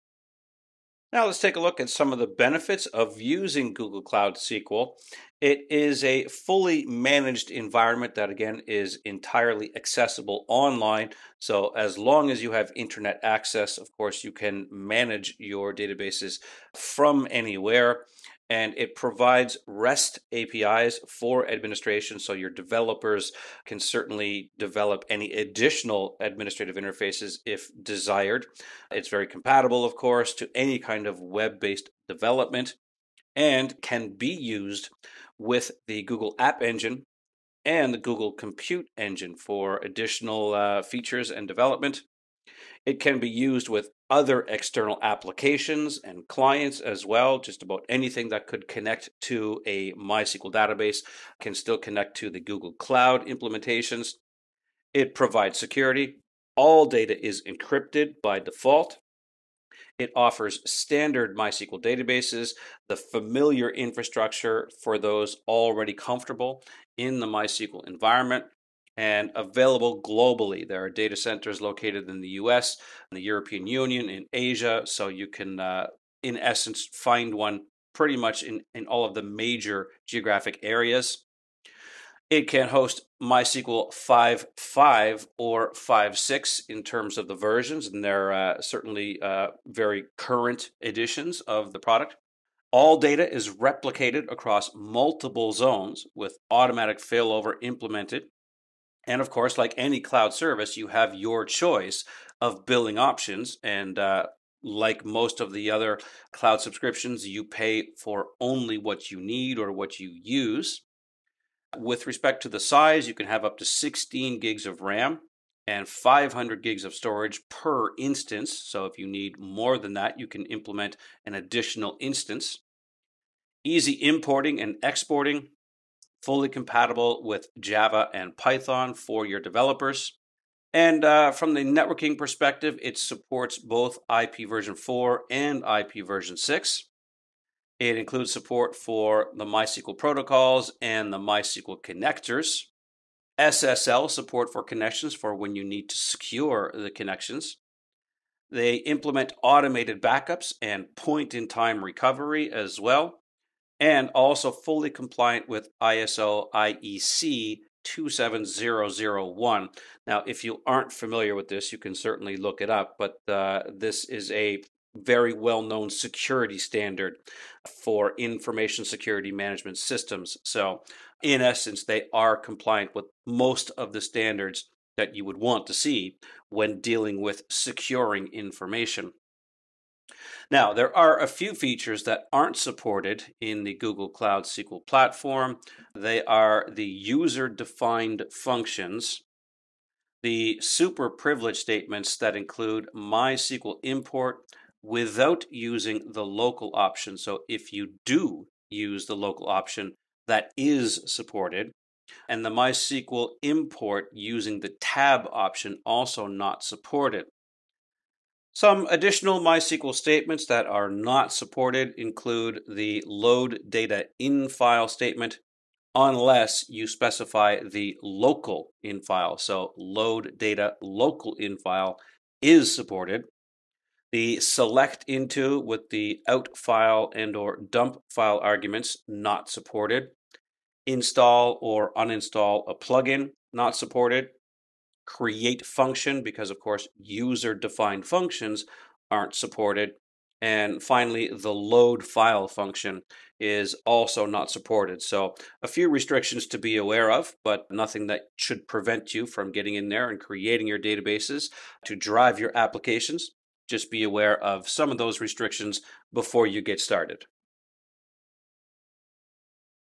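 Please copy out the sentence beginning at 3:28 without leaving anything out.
Some additional MySQL statements that are not supported include the load data in file statement, unless you specify the local in file.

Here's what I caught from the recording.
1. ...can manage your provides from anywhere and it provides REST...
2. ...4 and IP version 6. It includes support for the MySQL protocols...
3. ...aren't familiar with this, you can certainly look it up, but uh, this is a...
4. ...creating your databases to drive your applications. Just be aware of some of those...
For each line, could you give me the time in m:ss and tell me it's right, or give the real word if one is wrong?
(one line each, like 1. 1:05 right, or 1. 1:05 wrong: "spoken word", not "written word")
1. 0:14 wrong: "databases", not "provides"
2. 2:14 right
3. 2:40 right
4. 4:10 right.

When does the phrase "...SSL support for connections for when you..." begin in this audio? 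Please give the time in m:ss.
2:23.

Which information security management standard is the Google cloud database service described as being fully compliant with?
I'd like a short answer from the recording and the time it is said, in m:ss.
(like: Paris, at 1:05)
ISO IEC 27001, at 2:35.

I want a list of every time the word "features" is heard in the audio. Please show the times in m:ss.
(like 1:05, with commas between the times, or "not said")
0:40, 3:01.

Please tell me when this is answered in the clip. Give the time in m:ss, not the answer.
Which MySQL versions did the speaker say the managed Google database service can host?
1:23.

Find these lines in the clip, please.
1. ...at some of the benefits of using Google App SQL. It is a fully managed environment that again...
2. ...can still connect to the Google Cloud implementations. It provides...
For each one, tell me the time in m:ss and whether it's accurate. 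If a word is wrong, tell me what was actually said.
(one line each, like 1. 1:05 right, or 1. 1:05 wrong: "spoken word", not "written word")
1. 0:01 wrong: "Cloud", not "App"
2. 0:51 right.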